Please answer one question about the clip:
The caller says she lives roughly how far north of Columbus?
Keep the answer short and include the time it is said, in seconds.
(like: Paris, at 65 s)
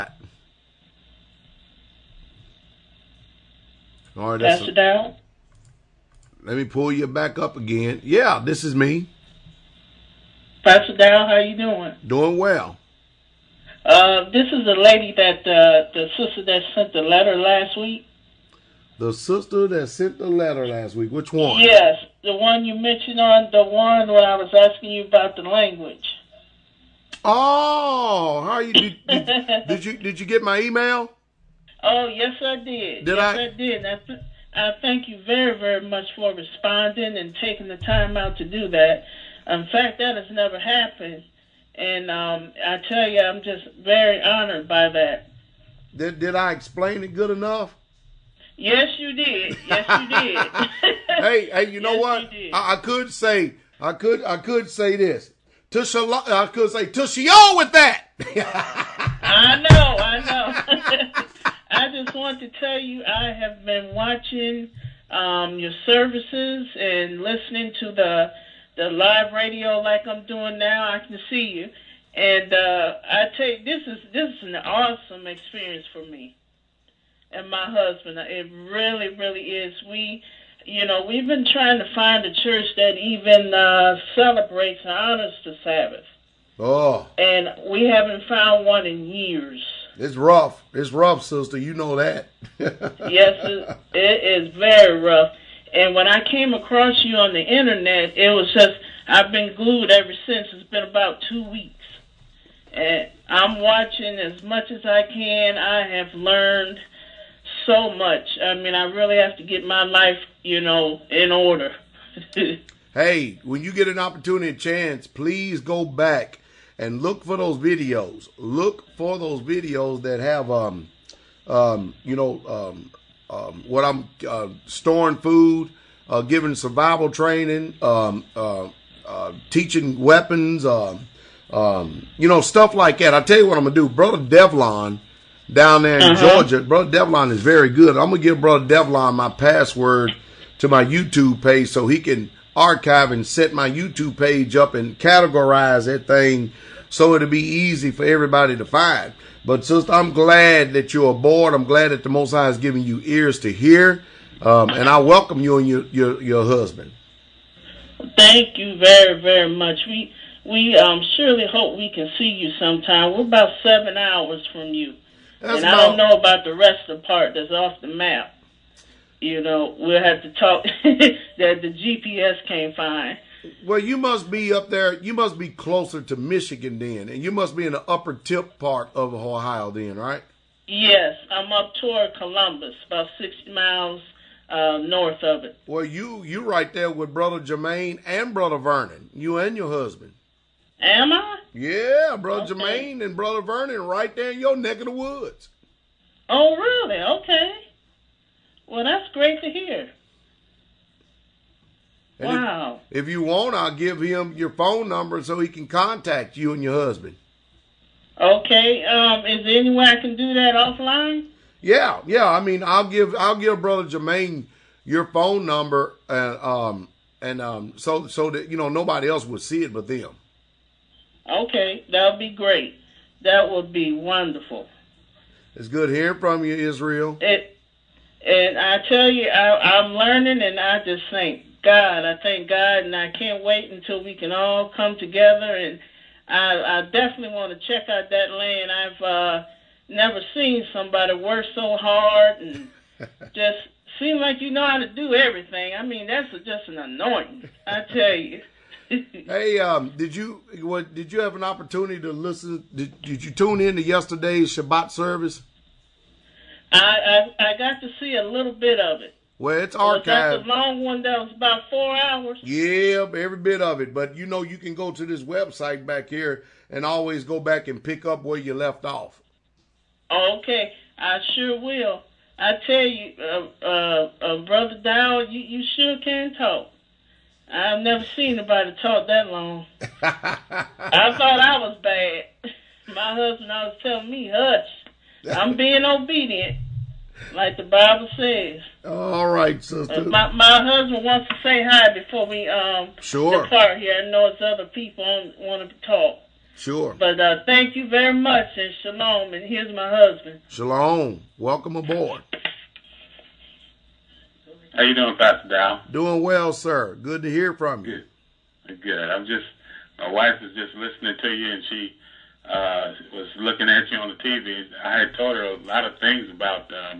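6 miles, at 183 s.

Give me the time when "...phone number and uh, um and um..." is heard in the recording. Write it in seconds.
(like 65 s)
215 s.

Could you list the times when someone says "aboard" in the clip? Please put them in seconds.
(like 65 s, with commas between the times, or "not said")
151 s, 301 s.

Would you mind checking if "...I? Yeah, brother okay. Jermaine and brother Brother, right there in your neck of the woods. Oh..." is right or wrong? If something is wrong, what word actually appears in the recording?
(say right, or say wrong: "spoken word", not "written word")
wrong: "Vernon", not "Brother".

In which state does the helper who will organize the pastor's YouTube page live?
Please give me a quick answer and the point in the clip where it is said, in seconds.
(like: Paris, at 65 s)
Georgia, at 136 s.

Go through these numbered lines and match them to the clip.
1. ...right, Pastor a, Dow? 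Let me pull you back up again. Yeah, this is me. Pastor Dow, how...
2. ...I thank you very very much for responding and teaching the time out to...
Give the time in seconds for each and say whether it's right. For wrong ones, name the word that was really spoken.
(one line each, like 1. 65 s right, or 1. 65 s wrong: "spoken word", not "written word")
1. 4 s right
2. 34 s wrong: "taking", not "teaching".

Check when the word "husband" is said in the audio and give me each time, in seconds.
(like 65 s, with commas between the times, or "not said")
77 s, 156 s, 189 s, 206 s, 283 s, 290 s, 299 s.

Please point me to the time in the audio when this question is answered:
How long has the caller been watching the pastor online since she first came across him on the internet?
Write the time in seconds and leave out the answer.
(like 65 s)
100 s.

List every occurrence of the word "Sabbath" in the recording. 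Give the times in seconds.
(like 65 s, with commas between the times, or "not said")
85 s.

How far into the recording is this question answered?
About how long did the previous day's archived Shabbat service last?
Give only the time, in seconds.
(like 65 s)
261 s.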